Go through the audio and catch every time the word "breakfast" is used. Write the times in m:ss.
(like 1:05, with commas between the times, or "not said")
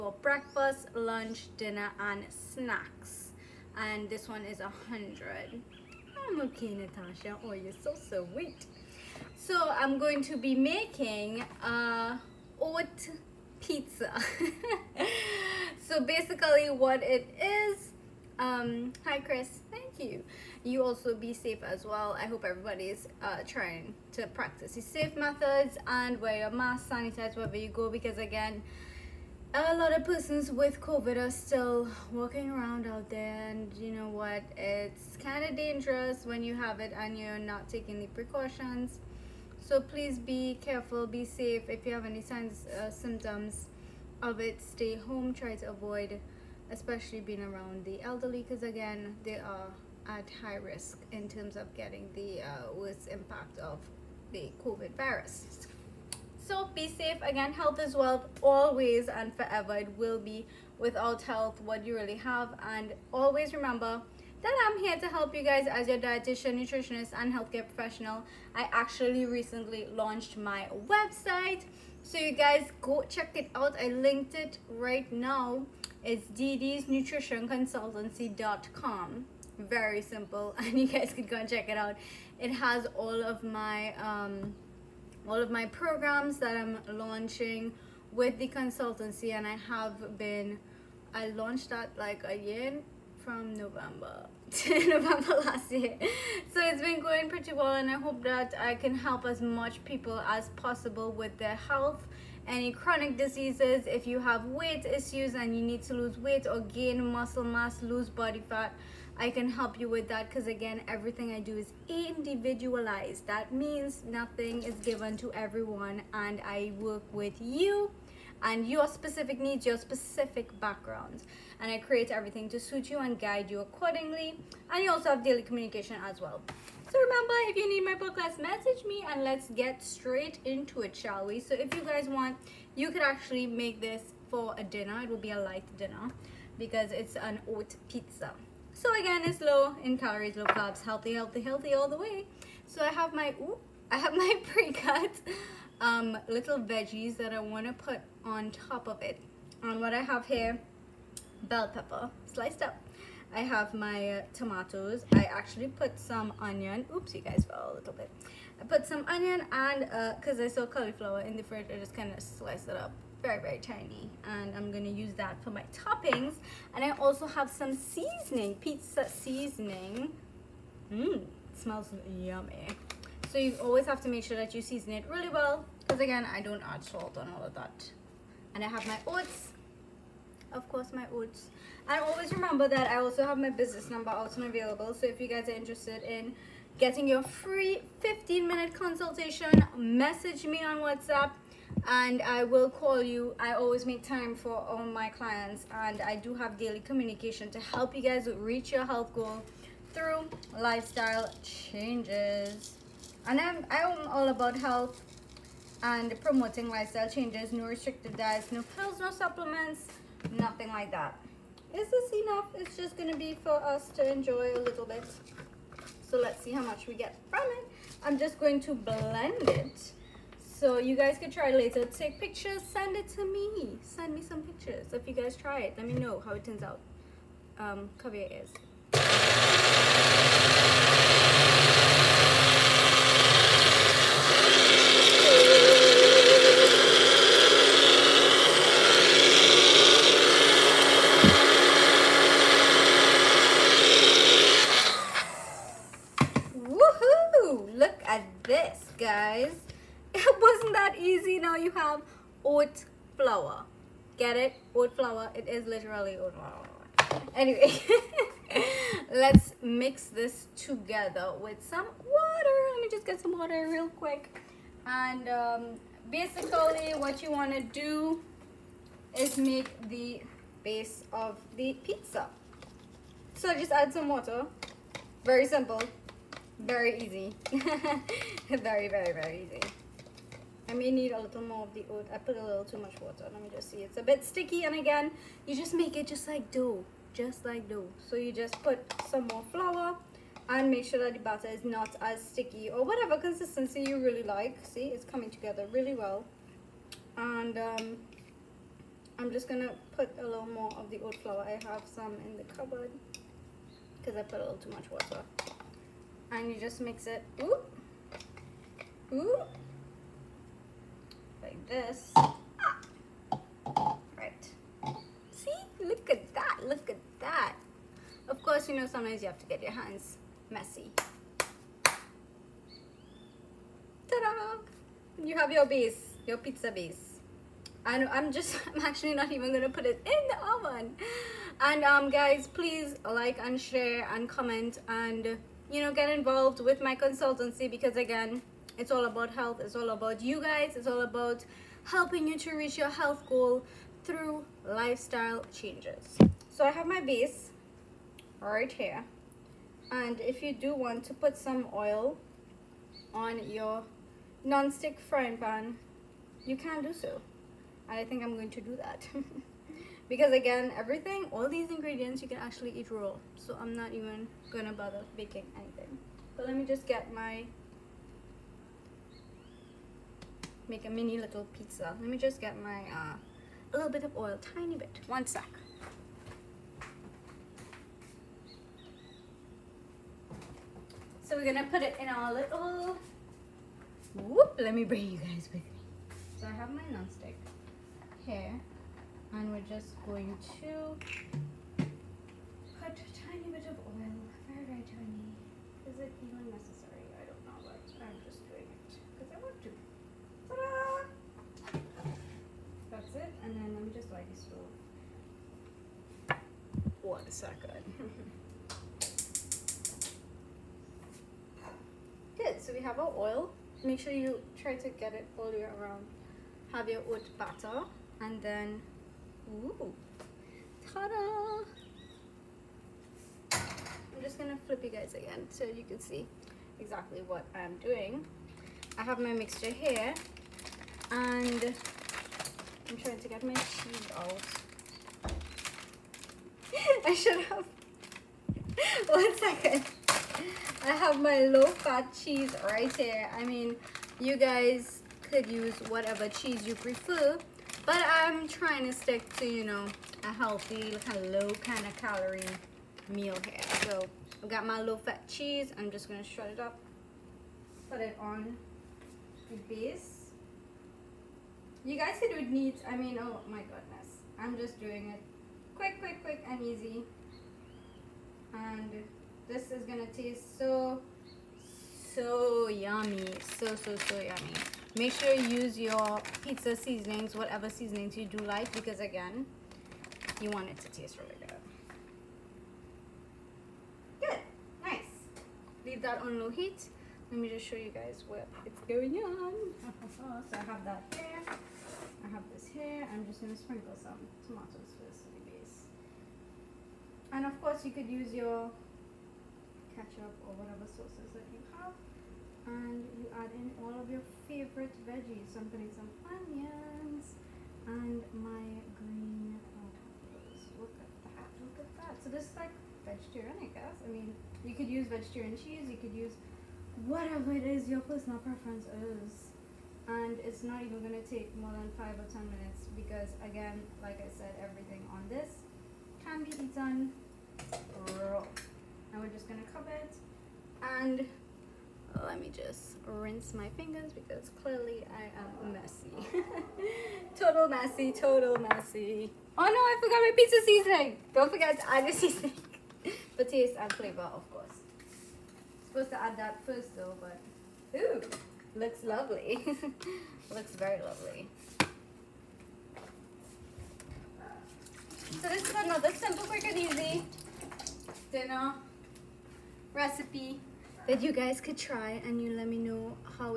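0:00.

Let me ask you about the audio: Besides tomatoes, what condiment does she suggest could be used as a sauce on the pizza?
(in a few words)
ketchup.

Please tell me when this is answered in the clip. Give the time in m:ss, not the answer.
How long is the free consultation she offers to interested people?
3:07.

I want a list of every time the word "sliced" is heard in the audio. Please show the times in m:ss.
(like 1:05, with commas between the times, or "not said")
2:32, 2:42.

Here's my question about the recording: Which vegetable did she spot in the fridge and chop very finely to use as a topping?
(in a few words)
cauliflower.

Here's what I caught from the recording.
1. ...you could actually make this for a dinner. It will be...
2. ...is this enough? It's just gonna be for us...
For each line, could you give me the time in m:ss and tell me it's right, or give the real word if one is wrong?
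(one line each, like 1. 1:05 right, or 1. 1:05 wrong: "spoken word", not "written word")
1. 2:12 right
2. 3:31 right.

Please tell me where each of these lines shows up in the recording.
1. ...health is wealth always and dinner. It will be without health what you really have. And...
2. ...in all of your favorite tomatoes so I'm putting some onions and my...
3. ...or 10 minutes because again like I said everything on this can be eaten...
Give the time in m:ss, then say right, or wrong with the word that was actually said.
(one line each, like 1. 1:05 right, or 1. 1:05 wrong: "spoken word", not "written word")
1. 0:57 wrong: "forever", not "dinner"
2. 8:23 wrong: "veggies", not "tomatoes"
3. 8:42 right.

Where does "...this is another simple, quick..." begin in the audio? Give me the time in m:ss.
9:15.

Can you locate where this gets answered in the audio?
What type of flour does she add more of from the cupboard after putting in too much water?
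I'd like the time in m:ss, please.
5:01.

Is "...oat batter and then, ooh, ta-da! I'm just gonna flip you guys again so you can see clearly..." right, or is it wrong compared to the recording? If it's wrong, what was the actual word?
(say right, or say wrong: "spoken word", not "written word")
wrong: "exactly", not "clearly".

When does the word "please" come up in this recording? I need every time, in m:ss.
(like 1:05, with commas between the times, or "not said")
0:39, 5:32.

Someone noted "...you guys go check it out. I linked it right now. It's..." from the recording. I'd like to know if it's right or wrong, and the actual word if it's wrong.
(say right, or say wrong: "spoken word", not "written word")
right.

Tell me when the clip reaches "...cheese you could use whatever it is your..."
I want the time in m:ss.
8:35.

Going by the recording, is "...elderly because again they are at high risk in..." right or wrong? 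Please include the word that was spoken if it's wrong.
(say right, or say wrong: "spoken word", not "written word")
right.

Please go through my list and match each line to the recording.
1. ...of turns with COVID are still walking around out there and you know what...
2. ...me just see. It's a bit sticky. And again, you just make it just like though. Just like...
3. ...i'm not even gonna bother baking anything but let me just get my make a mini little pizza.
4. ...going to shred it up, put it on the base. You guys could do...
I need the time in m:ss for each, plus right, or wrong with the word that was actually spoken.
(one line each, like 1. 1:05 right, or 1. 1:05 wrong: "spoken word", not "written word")
1. 0:29 wrong: "persons", not "turns"
2. 4:43 wrong: "dough", not "though"
3. 6:03 right
4. 7:36 right.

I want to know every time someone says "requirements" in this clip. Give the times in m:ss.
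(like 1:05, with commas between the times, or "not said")
not said.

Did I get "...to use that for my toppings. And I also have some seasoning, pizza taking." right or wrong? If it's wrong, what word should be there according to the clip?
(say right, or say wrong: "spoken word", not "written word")
wrong: "seasoning", not "taking".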